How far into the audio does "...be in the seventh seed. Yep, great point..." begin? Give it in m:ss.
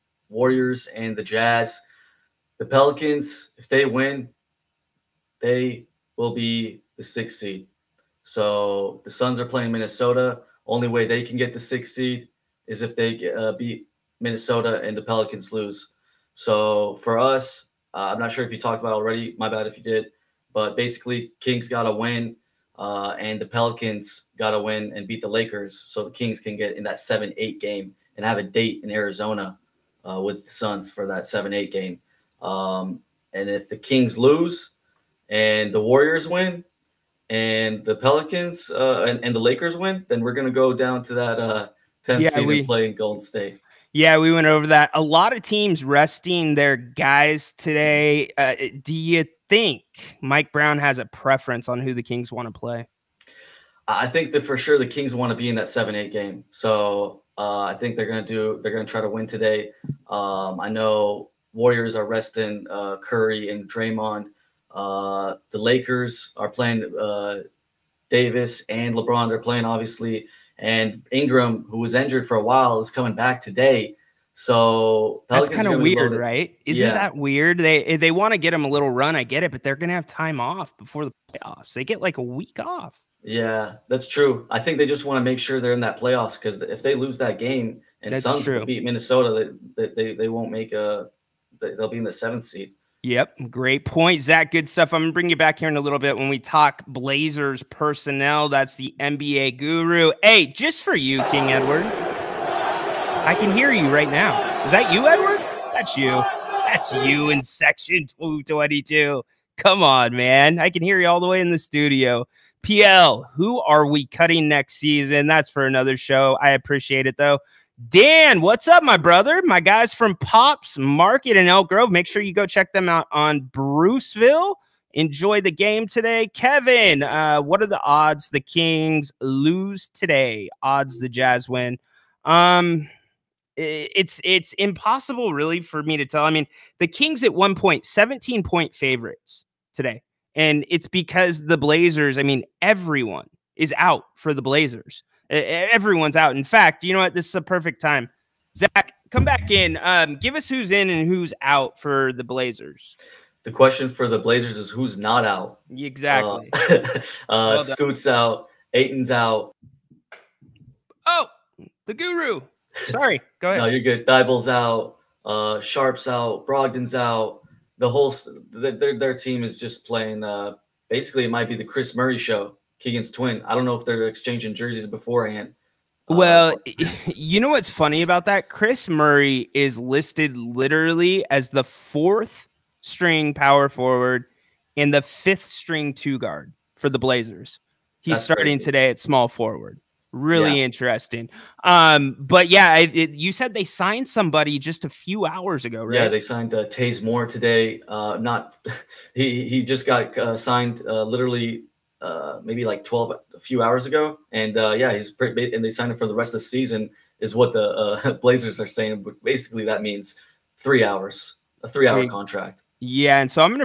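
1:31.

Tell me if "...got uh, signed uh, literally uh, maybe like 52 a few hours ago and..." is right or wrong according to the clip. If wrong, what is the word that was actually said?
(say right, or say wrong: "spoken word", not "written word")
wrong: "12", not "52".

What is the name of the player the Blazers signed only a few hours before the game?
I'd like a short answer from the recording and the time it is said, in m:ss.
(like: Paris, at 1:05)
Taze Moore, at 3:16.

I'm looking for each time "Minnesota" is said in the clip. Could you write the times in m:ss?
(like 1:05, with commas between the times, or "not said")
0:09, 0:14, 1:28.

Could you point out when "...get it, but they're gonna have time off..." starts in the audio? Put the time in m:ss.
1:19.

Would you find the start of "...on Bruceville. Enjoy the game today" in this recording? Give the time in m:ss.
2:03.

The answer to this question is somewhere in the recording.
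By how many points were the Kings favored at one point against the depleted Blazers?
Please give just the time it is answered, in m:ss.
2:17.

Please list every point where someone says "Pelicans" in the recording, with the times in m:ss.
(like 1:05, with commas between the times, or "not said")
0:02, 0:15, 0:23, 0:37, 1:15.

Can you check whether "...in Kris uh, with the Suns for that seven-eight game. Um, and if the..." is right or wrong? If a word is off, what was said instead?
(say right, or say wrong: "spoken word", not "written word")
wrong: "Arizona", not "Kris".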